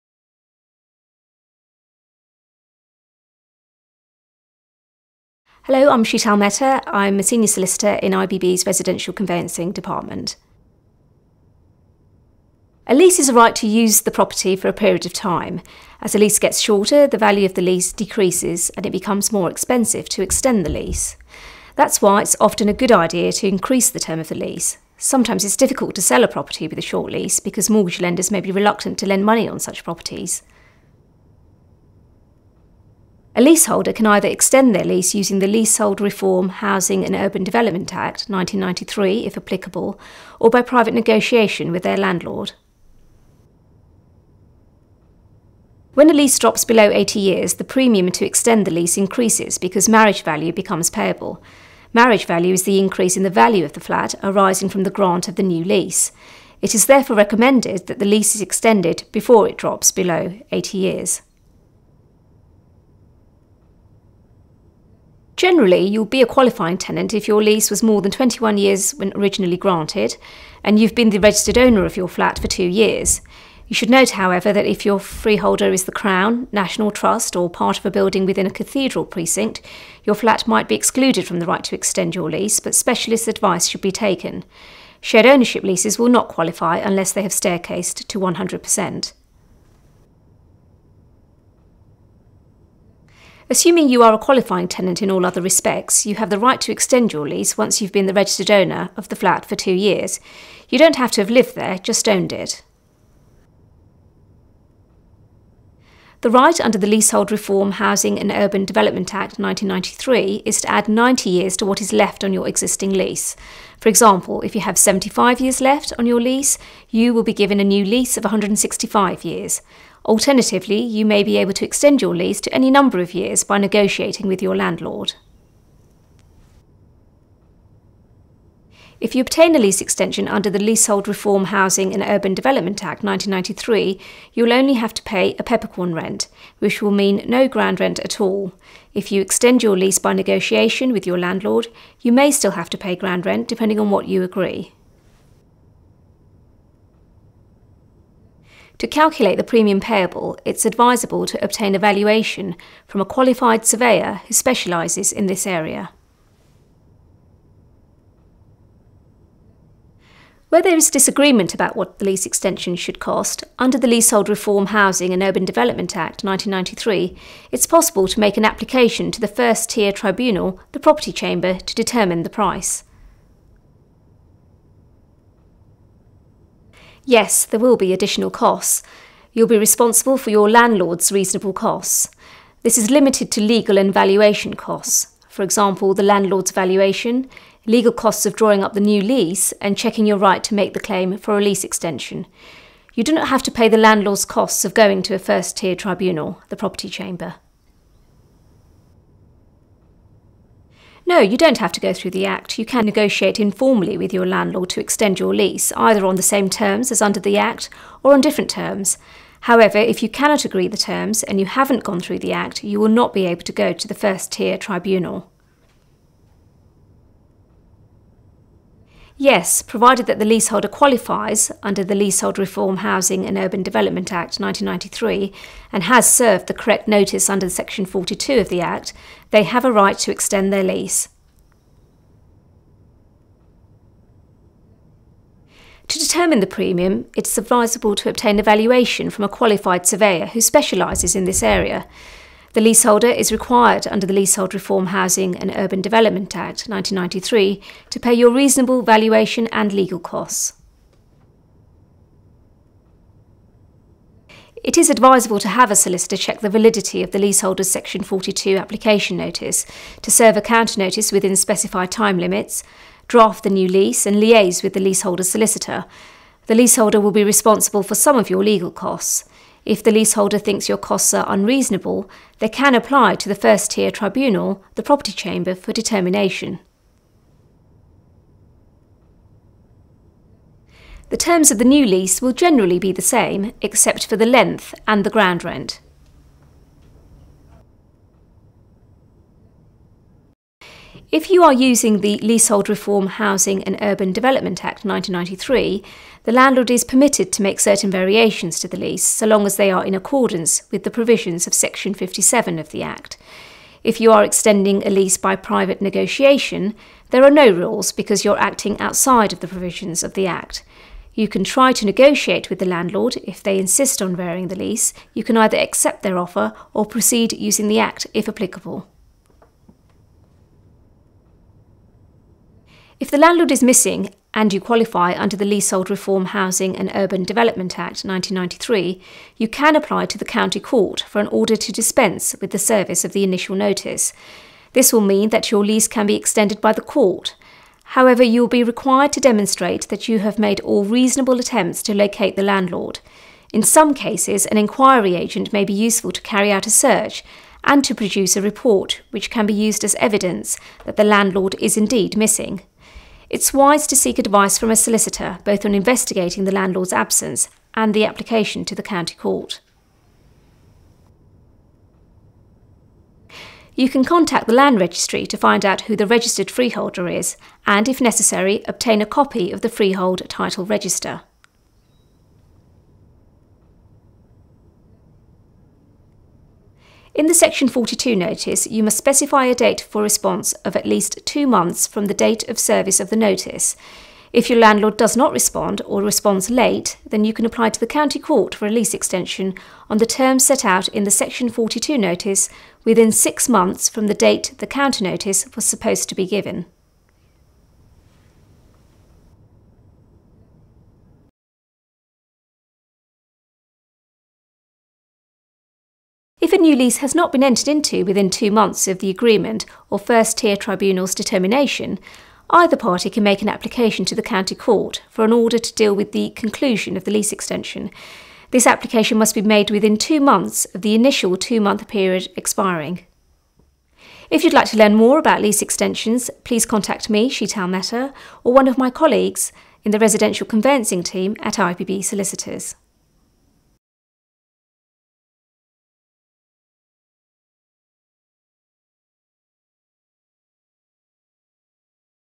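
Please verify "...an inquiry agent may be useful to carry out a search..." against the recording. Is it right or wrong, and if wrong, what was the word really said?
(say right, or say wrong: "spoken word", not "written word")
right.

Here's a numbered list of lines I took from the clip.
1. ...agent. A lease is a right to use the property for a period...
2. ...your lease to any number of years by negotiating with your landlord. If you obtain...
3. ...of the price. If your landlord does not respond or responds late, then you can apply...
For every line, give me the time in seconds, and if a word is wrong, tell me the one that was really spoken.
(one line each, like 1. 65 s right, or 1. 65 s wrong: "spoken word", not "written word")
1. 9 s wrong: "department", not "agent"
2. 122 s right
3. 383 s wrong: "notice", not "price".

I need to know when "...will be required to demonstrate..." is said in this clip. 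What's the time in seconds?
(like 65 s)
338 s.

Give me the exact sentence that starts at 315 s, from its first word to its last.
You can either accept their offer or proceed using the Act if applicable.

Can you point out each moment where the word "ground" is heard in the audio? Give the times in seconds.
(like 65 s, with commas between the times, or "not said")
137 s, 142 s, 285 s.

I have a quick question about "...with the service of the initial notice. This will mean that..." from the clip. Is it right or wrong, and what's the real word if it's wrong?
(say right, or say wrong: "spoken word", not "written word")
right.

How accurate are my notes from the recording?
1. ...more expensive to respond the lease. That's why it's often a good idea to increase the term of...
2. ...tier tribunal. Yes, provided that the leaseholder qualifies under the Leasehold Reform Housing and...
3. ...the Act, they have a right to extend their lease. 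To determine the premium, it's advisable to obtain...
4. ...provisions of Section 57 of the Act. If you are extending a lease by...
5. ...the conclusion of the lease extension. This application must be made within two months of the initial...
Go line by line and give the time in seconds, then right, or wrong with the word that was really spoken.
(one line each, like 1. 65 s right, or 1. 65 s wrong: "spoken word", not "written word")
1. 19 s wrong: "extend", not "respond"
2. 214 s right
3. 228 s right
4. 300 s right
5. 416 s right.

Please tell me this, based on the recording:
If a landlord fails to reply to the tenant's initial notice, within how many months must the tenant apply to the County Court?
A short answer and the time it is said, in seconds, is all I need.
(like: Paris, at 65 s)
6 months, at 393 s.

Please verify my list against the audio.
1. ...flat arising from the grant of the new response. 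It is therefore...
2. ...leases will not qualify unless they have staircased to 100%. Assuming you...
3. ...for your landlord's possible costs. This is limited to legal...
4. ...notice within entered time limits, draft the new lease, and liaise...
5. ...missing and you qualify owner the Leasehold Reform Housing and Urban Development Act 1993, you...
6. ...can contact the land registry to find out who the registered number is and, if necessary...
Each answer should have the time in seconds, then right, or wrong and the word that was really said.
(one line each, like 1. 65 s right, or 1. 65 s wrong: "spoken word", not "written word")
1. 53 s wrong: "lease", not "response"
2. 85 s right
3. 180 s wrong: "reasonable", not "possible"
4. 260 s wrong: "specified", not "entered"
5. 323 s wrong: "under", not "owner"
6. 363 s wrong: "freeholder", not "number".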